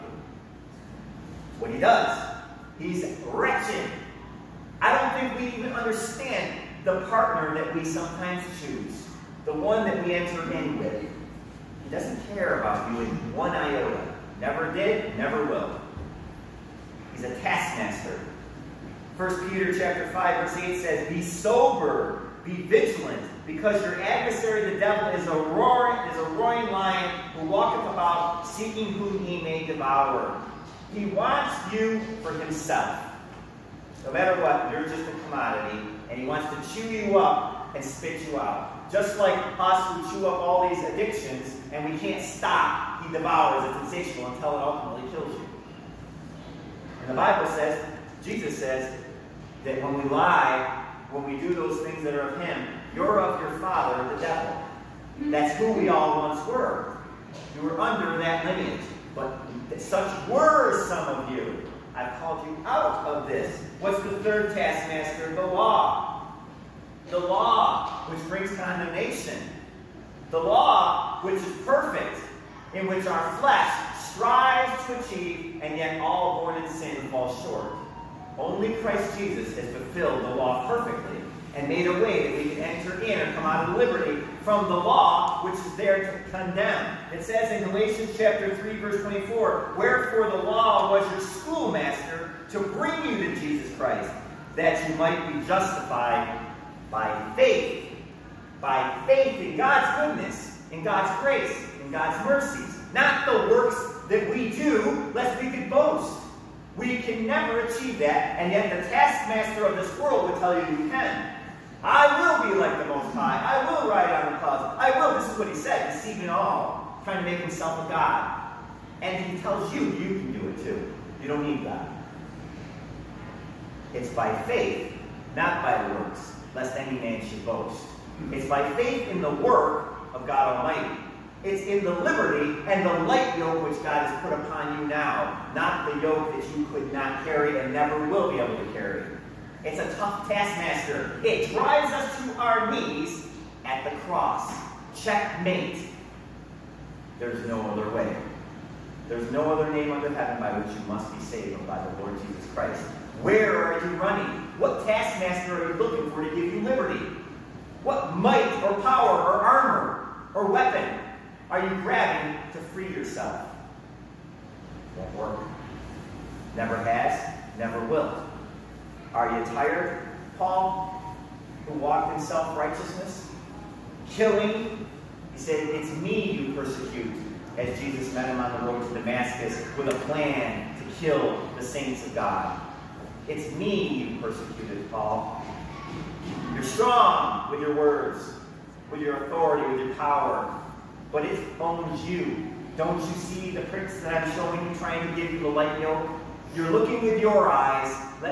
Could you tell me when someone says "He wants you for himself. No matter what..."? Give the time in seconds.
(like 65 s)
30 s.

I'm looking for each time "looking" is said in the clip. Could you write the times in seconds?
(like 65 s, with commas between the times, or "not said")
155 s, 196 s.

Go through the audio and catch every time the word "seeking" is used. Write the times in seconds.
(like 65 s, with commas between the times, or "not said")
28 s.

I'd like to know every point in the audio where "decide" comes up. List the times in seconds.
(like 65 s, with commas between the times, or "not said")
not said.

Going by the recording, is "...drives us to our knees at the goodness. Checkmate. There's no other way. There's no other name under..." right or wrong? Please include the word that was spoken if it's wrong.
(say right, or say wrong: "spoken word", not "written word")
wrong: "cross", not "goodness".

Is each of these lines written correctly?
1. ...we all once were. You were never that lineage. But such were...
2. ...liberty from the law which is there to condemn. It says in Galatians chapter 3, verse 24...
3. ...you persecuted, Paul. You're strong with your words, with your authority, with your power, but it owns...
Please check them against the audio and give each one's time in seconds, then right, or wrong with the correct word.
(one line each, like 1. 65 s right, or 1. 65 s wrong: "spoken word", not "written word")
1. 55 s wrong: "under", not "never"
2. 83 s right
3. 184 s right.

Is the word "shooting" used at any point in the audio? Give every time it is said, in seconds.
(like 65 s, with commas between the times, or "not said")
not said.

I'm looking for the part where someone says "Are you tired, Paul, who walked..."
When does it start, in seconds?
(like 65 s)
169 s.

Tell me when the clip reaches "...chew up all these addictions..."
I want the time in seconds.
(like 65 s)
40 s.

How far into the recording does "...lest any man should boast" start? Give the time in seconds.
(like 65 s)
126 s.